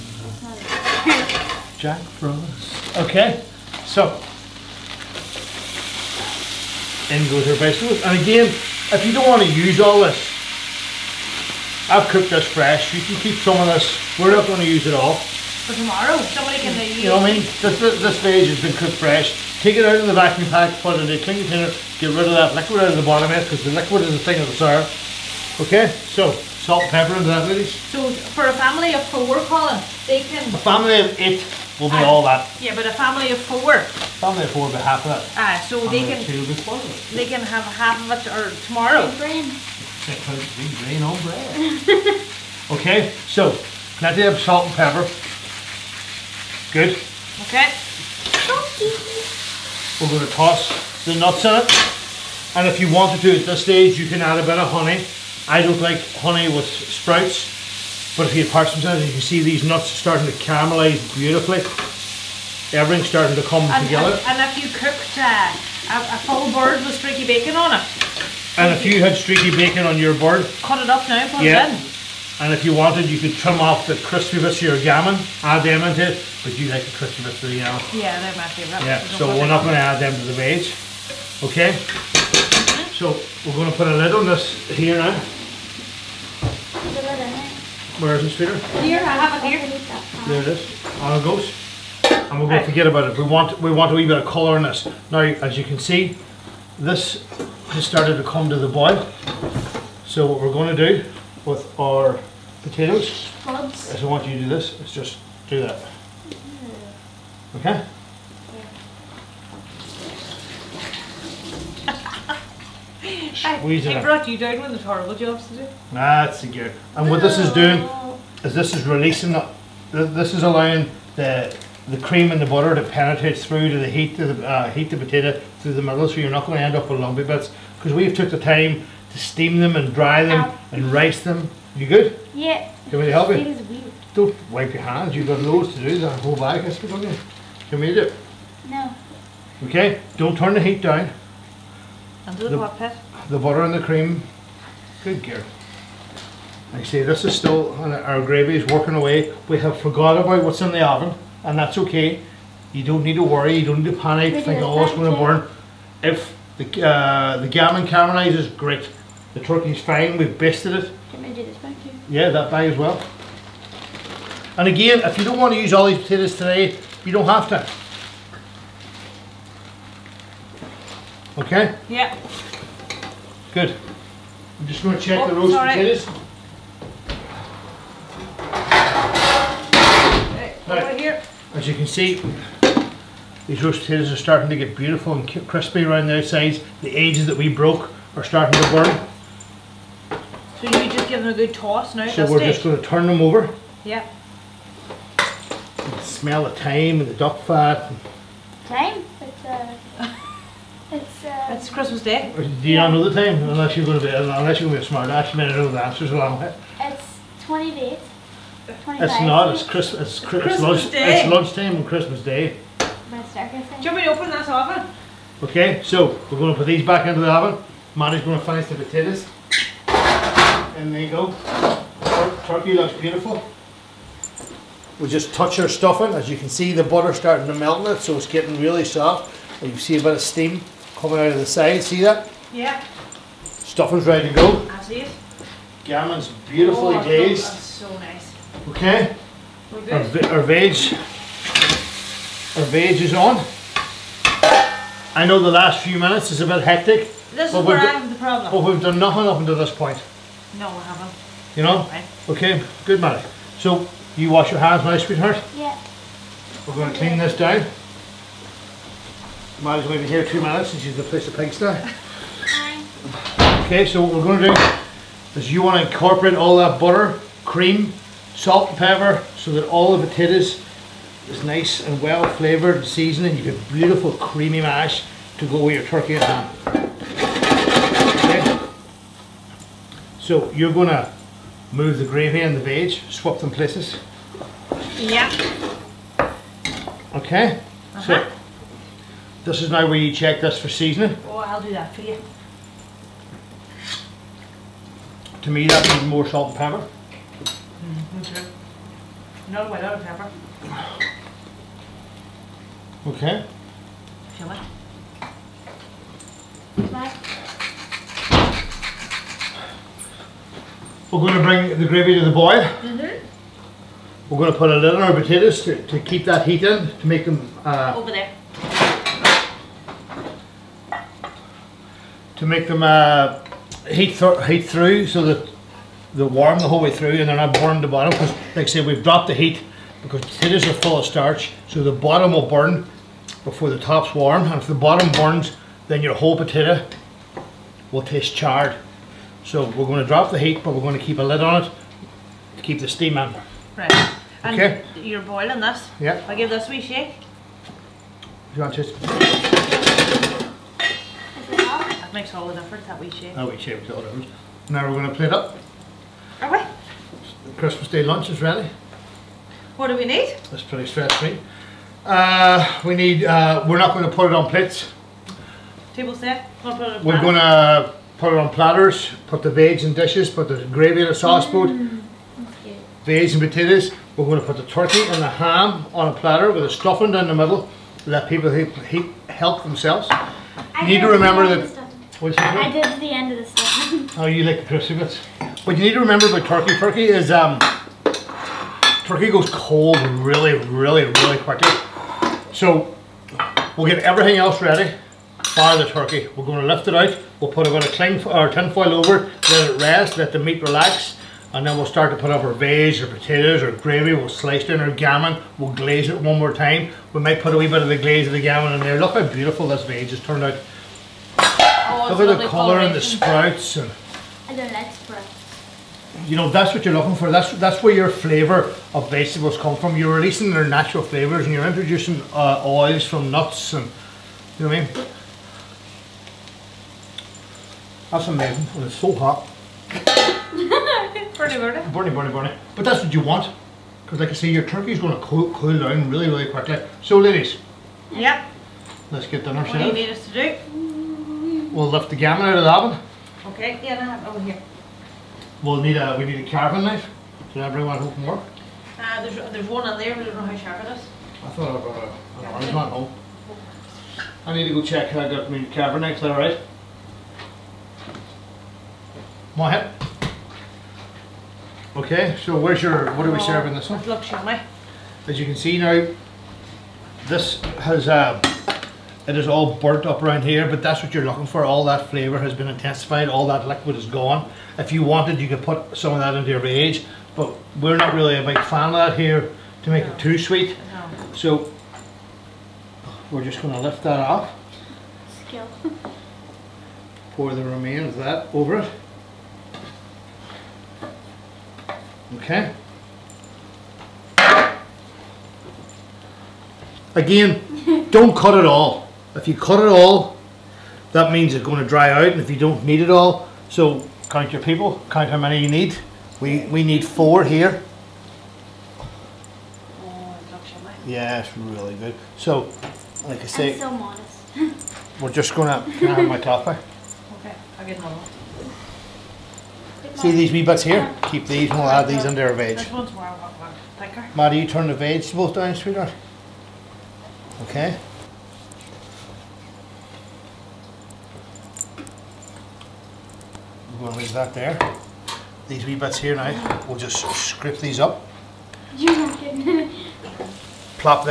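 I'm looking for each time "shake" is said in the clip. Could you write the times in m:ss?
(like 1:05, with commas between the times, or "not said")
5:46.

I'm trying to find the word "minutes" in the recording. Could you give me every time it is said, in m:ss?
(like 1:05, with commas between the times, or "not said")
4:05, 4:20.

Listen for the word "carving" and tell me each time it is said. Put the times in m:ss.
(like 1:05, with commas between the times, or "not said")
7:26, 7:35.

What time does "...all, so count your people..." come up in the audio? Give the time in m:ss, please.
8:23.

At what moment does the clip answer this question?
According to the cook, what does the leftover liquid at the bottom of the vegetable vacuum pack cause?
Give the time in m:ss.
0:24.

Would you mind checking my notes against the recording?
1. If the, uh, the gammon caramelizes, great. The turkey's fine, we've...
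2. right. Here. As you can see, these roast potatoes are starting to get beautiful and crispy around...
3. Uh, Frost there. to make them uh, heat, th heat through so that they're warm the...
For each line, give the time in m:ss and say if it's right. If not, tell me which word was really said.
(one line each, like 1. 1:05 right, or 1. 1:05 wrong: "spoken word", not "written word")
1. 2:36 right
2. 3:00 right
3. 5:17 wrong: "Over", not "Frost".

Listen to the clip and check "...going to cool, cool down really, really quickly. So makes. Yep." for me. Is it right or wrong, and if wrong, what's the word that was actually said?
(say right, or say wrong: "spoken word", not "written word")
wrong: "ladies", not "makes".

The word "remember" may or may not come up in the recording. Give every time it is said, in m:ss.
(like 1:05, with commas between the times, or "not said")
6:21, 6:25.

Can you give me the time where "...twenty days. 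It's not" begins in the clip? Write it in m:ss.
3:27.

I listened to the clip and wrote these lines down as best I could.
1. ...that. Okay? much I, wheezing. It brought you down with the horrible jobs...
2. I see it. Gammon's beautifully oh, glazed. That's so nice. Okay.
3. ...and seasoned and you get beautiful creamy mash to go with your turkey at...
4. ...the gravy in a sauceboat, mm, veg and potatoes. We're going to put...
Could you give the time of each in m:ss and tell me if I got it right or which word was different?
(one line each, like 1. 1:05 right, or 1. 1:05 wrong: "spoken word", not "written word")
1. 1:45 right
2. 3:54 right
3. 4:32 right
4. 6:10 right.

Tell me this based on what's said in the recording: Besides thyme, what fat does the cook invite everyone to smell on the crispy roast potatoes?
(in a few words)
duck fat.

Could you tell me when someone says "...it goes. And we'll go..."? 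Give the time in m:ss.
1:31.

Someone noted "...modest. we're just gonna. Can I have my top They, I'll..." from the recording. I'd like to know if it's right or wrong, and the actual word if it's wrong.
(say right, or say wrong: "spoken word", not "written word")
wrong: "Okay", not "They".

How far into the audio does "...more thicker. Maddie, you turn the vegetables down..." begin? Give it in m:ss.
8:43.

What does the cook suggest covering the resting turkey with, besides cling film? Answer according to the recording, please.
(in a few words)
tin foil.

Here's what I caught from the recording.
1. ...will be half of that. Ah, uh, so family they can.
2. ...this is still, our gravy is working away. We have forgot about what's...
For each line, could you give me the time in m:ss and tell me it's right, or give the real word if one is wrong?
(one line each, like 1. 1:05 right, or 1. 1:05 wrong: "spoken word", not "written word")
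1. 0:34 right
2. 2:27 right.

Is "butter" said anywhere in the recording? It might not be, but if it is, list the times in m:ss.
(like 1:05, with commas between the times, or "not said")
2:02, 2:23, 3:46, 4:26.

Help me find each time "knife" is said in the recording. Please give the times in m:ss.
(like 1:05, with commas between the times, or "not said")
7:26, 7:36.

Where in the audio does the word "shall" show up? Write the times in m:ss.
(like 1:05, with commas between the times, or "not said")
5:04, 7:44.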